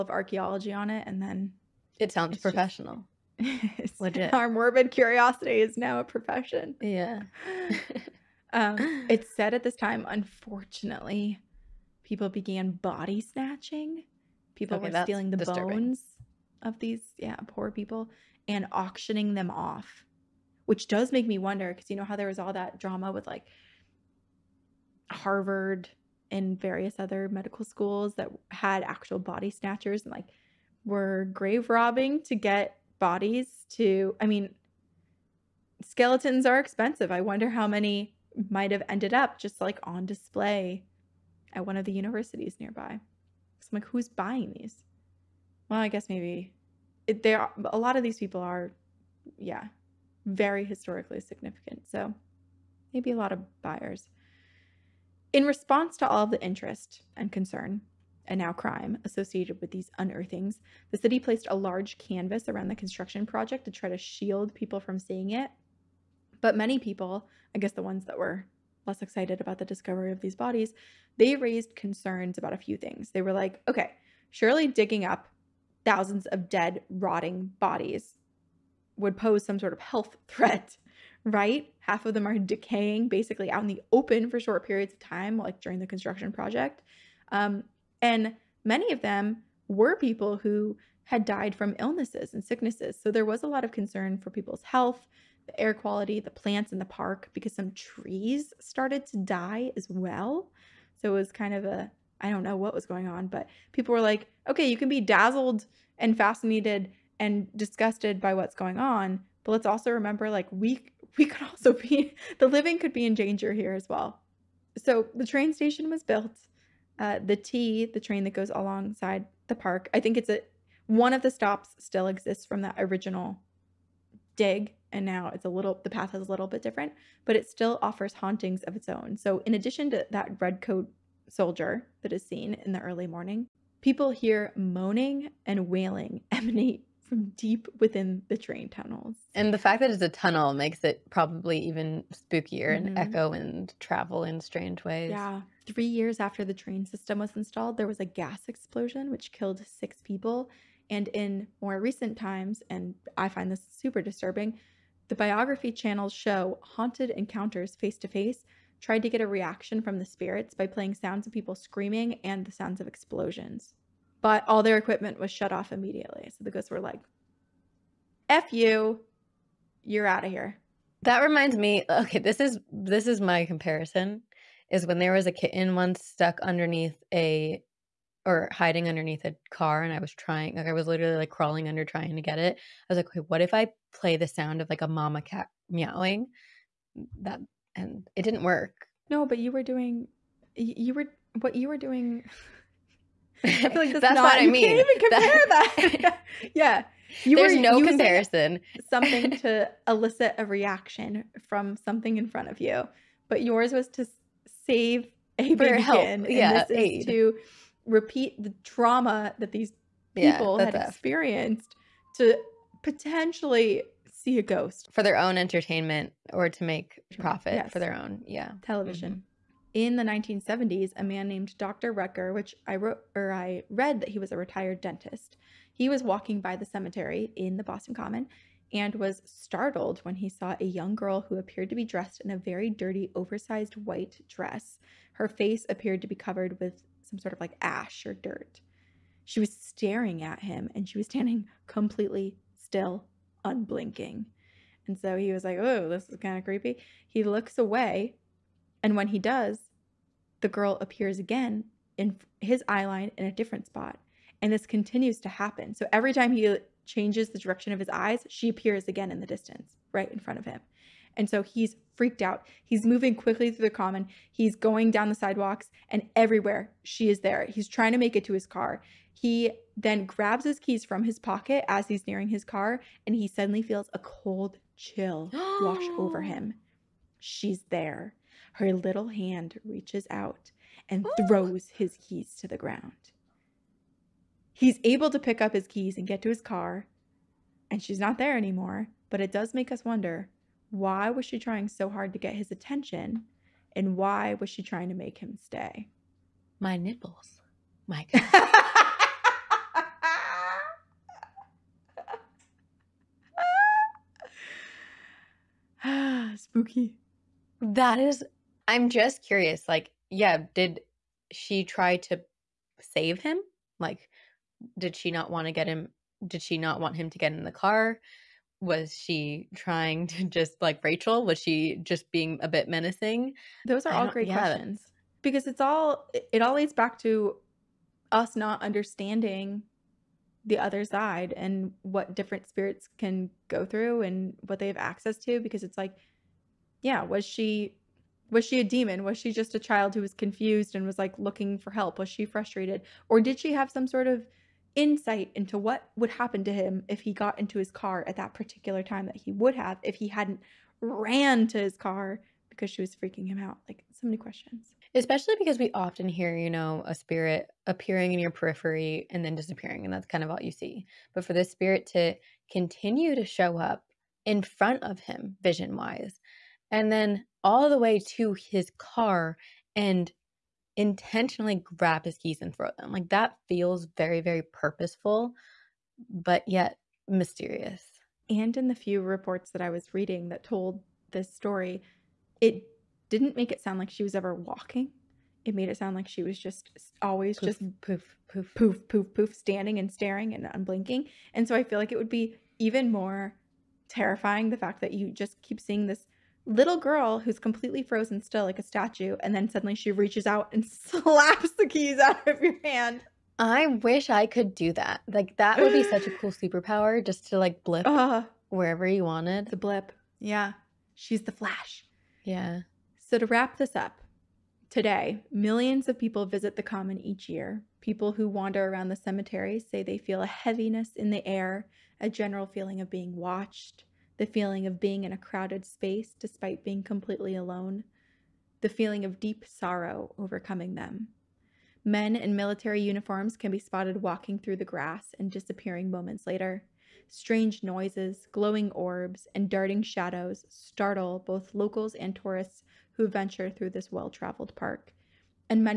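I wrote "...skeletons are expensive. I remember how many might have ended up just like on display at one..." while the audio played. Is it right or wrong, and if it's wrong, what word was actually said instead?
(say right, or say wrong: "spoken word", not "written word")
wrong: "wonder", not "remember".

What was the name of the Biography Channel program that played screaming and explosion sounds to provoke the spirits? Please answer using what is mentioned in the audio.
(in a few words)
Haunted Encounters Face to Face.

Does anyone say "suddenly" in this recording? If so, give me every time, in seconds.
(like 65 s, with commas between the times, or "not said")
273 s, 399 s.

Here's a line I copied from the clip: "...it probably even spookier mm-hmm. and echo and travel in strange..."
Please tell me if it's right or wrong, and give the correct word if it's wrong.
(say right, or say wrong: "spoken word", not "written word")
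right.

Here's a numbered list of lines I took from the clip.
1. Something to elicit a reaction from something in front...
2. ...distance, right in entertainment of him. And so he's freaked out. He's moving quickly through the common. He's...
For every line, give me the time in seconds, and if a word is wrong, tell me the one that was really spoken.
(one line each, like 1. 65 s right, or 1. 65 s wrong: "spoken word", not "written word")
1. 198 s right
2. 259 s wrong: "front", not "entertainment".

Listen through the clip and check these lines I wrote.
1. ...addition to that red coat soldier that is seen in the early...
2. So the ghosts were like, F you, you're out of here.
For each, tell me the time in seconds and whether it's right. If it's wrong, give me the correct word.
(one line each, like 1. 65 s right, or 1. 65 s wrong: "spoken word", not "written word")
1. 129 s right
2. 166 s right.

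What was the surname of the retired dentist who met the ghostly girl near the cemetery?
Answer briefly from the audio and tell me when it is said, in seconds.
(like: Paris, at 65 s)
Rucker, at 221 s.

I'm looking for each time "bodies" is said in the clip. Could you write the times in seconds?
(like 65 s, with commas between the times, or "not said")
32 s, 70 s, 77 s.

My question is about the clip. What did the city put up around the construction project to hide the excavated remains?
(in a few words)
A large canvas.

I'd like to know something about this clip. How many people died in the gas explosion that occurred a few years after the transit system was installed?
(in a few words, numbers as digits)
6.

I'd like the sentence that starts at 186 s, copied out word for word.
Mm, that and it didn't work.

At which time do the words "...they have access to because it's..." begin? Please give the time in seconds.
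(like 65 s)
334 s.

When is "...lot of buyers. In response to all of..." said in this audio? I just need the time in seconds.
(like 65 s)
53 s.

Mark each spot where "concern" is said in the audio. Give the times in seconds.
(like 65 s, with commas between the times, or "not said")
57 s, 71 s, 93 s.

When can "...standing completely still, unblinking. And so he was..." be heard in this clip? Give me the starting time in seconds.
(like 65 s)
241 s.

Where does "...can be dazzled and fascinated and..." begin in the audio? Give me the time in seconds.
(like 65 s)
104 s.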